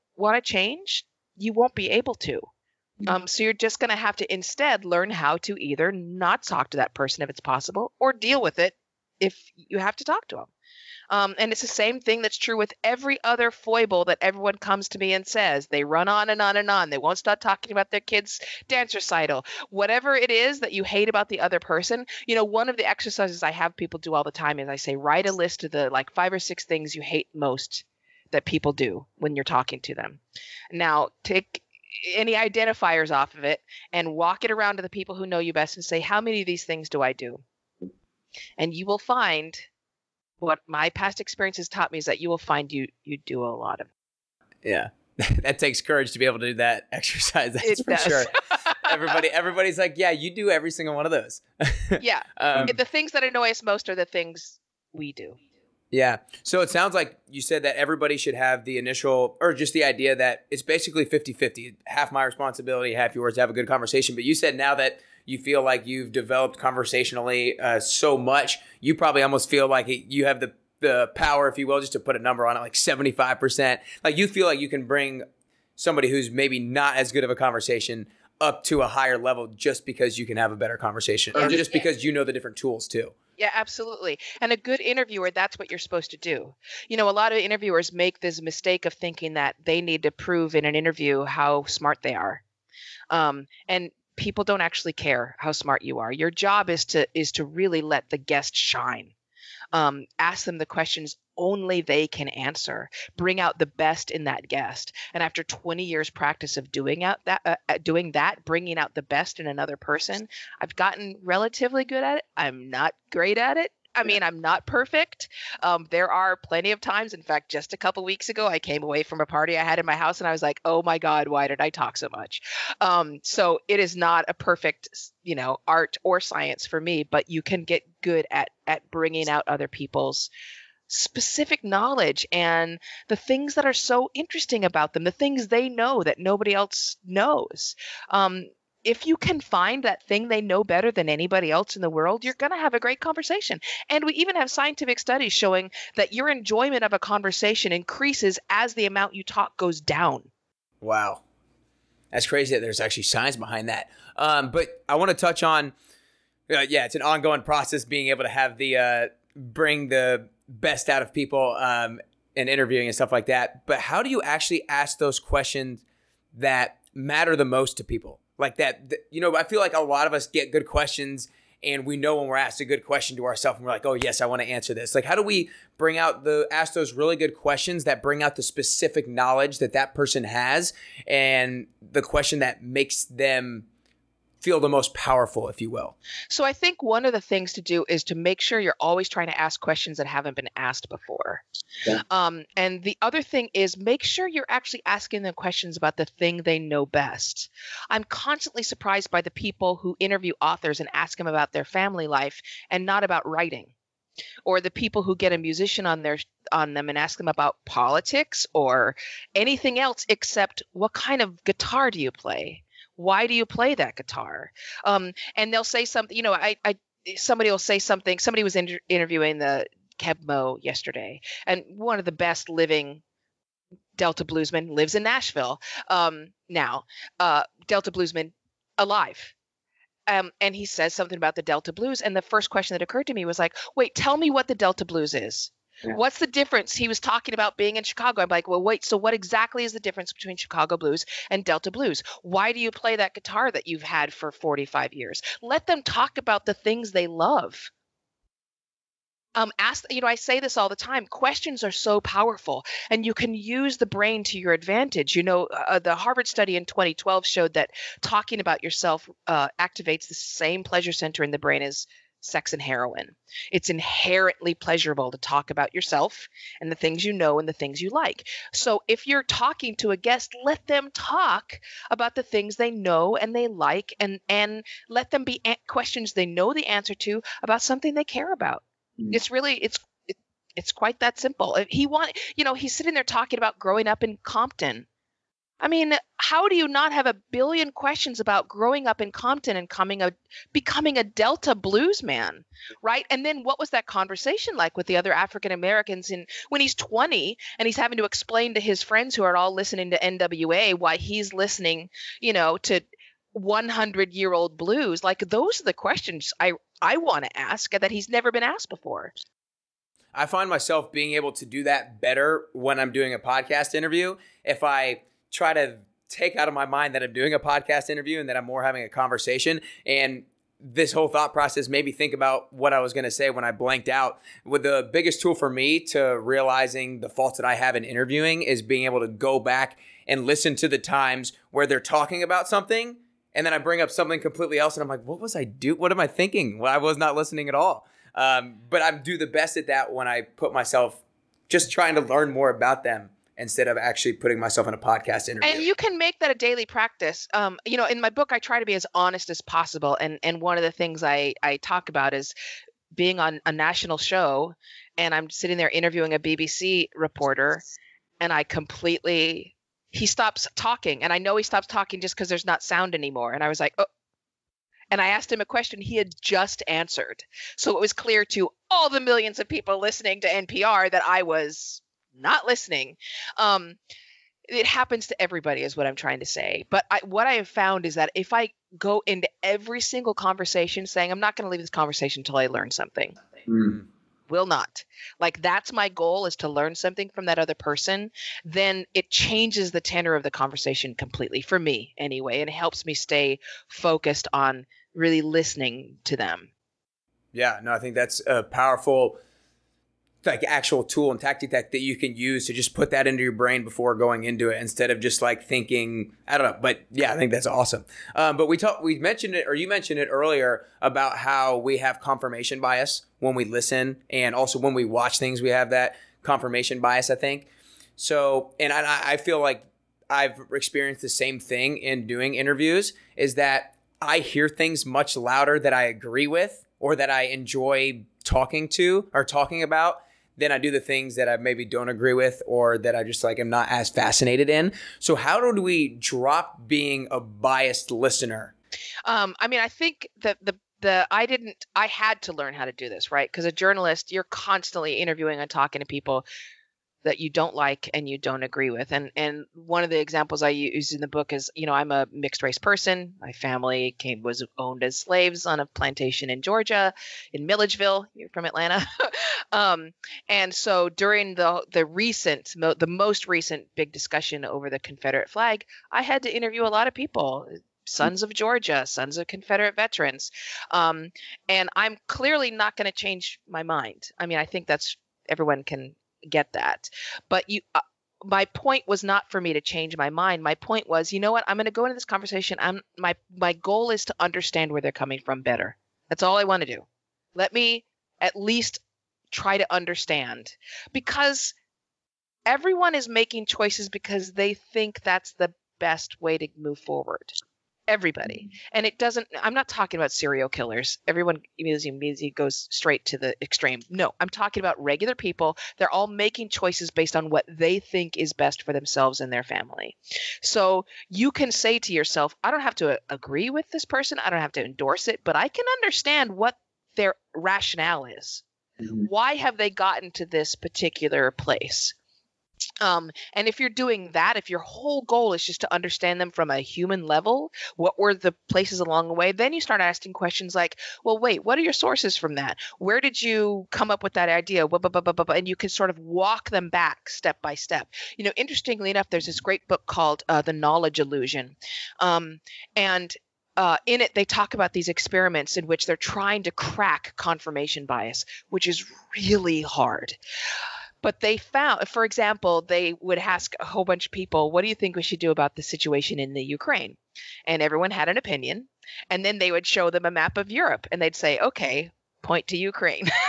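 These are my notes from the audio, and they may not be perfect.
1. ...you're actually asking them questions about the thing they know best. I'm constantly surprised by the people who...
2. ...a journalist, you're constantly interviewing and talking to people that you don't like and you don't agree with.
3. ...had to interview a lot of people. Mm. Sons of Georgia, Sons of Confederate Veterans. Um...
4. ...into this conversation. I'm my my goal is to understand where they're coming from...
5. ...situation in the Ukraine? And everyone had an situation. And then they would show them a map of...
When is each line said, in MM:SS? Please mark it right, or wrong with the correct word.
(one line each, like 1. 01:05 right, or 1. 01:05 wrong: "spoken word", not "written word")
1. 03:14 right
2. 07:23 right
3. 07:46 right
4. 08:01 right
5. 09:15 wrong: "opinion", not "situation".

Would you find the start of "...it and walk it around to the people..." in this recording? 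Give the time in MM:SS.
00:33.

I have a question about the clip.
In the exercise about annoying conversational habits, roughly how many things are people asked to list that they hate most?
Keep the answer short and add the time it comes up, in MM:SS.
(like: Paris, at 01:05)
5 or 6, at 00:26.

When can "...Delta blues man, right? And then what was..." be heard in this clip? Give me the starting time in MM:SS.
04:51.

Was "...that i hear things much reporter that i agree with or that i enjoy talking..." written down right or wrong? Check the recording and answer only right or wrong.
wrong.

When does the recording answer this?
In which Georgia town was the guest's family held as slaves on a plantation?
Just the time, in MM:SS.
07:37.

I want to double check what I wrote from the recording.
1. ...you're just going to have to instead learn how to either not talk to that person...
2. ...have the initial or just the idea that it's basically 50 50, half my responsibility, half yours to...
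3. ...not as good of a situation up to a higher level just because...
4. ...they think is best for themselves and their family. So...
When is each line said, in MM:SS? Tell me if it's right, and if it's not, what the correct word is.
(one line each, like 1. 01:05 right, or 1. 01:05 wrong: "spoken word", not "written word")
1. 00:03 right
2. 00:58 right
3. 01:16 wrong: "conversation", not "situation"
4. 08:27 right.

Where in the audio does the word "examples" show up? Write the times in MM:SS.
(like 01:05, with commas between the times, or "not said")
07:29, 09:12.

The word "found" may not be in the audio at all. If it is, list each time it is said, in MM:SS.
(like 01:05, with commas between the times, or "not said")
06:17, 09:11.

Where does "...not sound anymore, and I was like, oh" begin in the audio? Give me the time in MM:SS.
06:02.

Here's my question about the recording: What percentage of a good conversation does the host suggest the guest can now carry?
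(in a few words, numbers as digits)
75%.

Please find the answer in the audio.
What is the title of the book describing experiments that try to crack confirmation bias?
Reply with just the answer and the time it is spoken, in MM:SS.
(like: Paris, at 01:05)
The Knowledge Illusion, at 09:00.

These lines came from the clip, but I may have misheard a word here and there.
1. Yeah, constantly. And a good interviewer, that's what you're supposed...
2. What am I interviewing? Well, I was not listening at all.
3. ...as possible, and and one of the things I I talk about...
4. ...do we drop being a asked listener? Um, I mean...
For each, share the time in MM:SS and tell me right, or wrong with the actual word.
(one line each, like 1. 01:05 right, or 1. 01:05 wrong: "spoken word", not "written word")
1. 01:23 wrong: "absolutely", not "constantly"
2. 05:35 wrong: "thinking", not "interviewing"
3. 05:49 right
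4. 07:15 wrong: "biased", not "asked".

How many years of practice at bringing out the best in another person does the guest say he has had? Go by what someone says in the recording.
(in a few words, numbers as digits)
20 years.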